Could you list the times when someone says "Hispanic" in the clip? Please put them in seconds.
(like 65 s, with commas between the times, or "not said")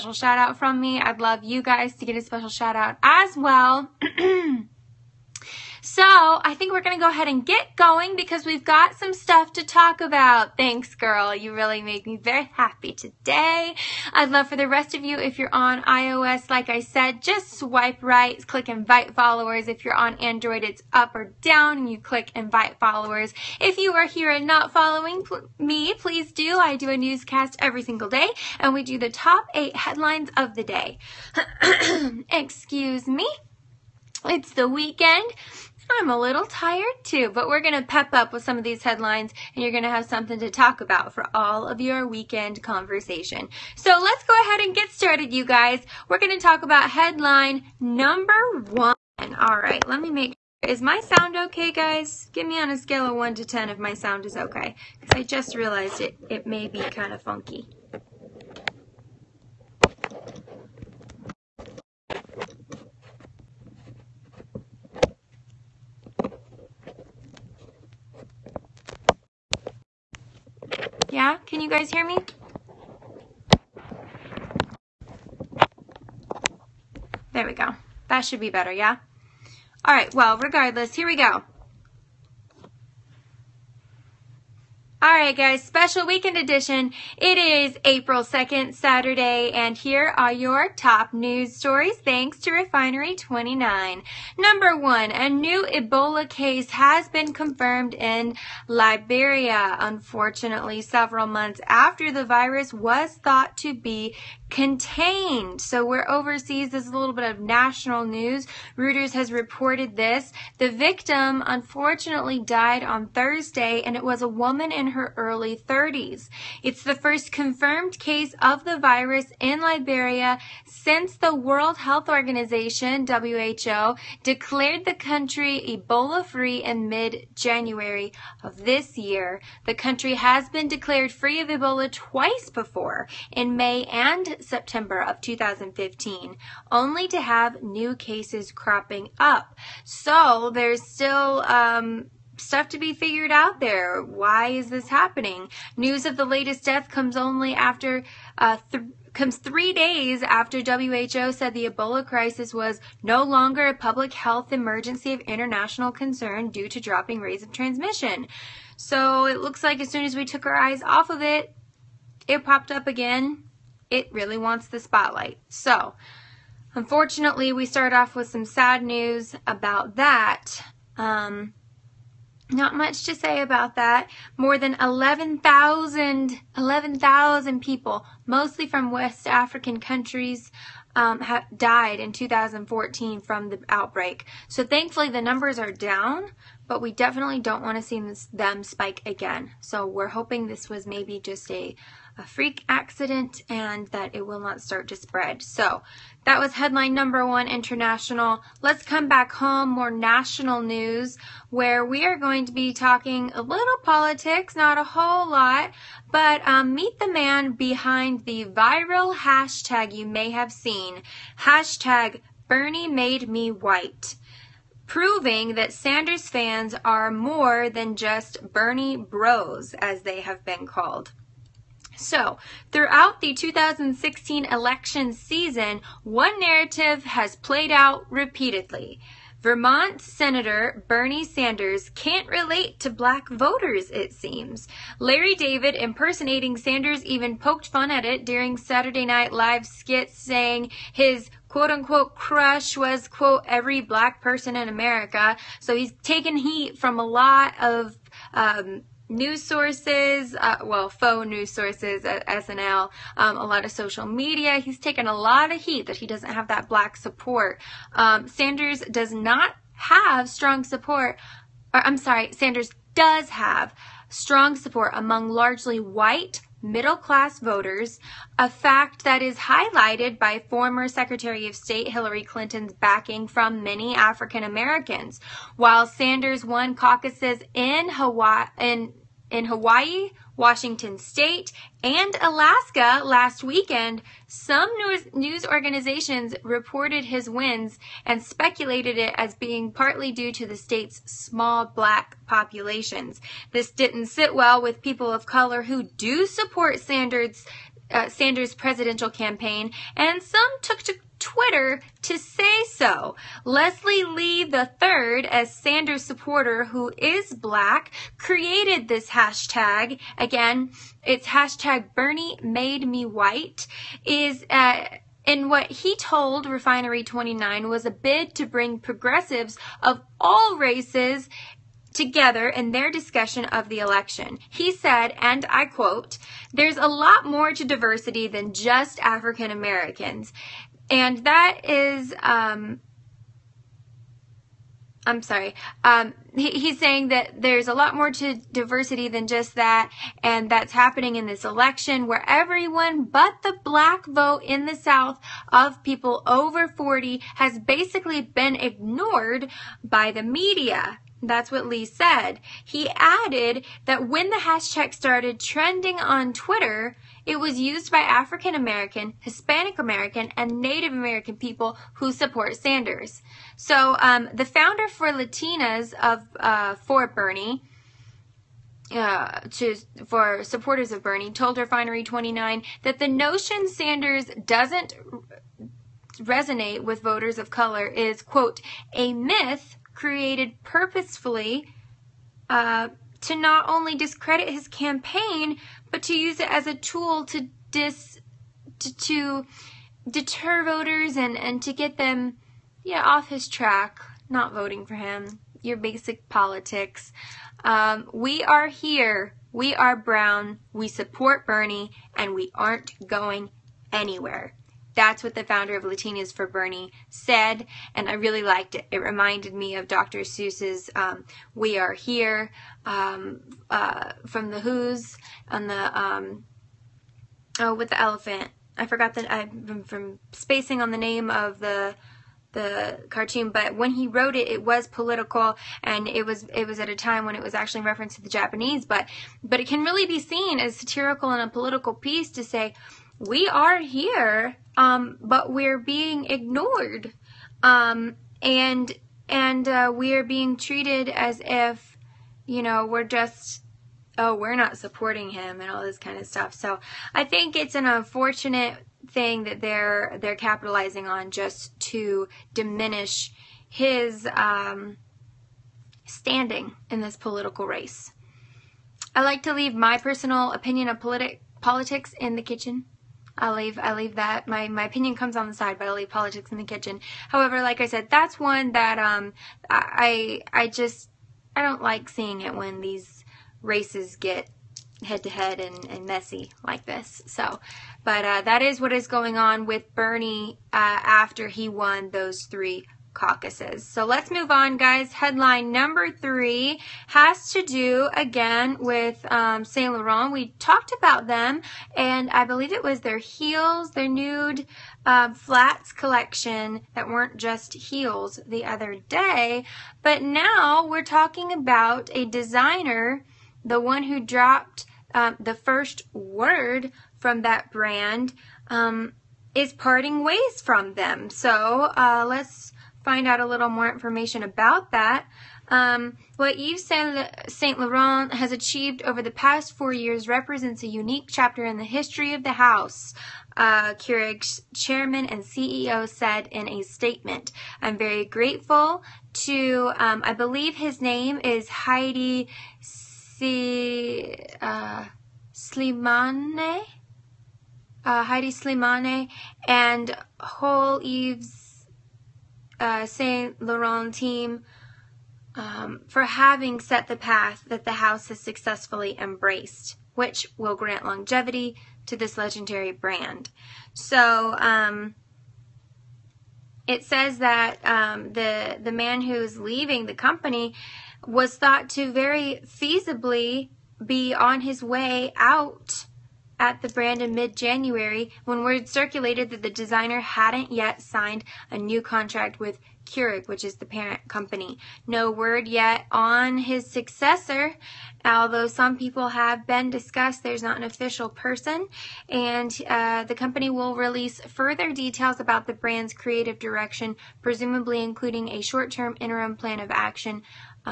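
359 s.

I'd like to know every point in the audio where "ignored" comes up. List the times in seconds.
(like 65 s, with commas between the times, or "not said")
348 s, 436 s.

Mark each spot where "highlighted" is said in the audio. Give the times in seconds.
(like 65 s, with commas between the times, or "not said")
269 s.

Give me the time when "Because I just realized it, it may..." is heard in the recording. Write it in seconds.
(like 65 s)
54 s.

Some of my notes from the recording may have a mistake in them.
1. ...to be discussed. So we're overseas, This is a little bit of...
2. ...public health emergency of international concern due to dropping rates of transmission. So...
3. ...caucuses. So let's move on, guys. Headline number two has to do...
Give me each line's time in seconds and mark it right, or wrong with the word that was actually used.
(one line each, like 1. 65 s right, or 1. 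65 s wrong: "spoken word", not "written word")
1. 103 s wrong: "contained", not "discussed"
2. 153 s right
3. 483 s wrong: "three", not "two".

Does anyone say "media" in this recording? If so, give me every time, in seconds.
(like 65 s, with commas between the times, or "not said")
254 s, 350 s.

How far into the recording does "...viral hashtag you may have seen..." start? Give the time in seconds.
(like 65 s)
208 s.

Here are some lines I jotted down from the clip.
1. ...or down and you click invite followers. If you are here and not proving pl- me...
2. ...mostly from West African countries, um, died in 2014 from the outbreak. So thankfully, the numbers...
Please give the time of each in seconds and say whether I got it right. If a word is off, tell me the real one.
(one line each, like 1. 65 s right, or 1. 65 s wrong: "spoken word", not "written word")
1. 21 s wrong: "following", not "proving"
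2. 178 s right.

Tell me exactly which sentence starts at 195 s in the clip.
So that was headline number one international.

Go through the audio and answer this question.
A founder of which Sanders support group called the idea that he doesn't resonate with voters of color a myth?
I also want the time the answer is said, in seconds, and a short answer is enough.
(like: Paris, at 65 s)
Latinas for Bernie, at 405 s.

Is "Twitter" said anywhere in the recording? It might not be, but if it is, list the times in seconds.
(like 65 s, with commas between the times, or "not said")
301 s, 356 s.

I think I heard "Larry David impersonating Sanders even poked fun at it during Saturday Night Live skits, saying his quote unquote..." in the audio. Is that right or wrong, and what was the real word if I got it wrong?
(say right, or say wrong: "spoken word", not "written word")
right.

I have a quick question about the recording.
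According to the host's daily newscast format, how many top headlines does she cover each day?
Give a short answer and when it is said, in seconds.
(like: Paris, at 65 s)
8, at 29 s.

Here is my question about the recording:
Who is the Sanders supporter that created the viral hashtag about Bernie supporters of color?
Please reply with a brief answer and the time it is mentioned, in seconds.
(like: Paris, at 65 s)
Leslie Lee III, at 303 s.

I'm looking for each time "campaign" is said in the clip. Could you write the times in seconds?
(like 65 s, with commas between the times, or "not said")
299 s, 384 s.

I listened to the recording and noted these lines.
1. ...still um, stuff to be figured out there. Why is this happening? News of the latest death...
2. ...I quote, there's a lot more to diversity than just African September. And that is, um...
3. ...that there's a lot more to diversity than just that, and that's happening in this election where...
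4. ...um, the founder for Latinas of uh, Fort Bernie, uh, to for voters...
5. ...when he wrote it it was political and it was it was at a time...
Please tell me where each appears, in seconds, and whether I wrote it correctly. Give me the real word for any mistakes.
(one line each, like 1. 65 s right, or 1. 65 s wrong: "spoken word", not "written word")
1. 140 s right
2. 325 s wrong: "Americans", not "September"
3. 337 s right
4. 363 s wrong: "supporters", not "voters"
5. 423 s right.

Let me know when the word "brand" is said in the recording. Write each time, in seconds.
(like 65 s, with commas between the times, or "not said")
507 s, 552 s, 566 s, 585 s.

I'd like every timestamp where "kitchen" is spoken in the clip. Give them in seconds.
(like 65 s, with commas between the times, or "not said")
462 s, 466 s.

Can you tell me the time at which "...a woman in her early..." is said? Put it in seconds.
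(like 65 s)
114 s.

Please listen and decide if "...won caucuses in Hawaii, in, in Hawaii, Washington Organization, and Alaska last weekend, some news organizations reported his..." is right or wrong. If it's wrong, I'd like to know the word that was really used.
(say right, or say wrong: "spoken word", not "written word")
wrong: "State", not "Organization".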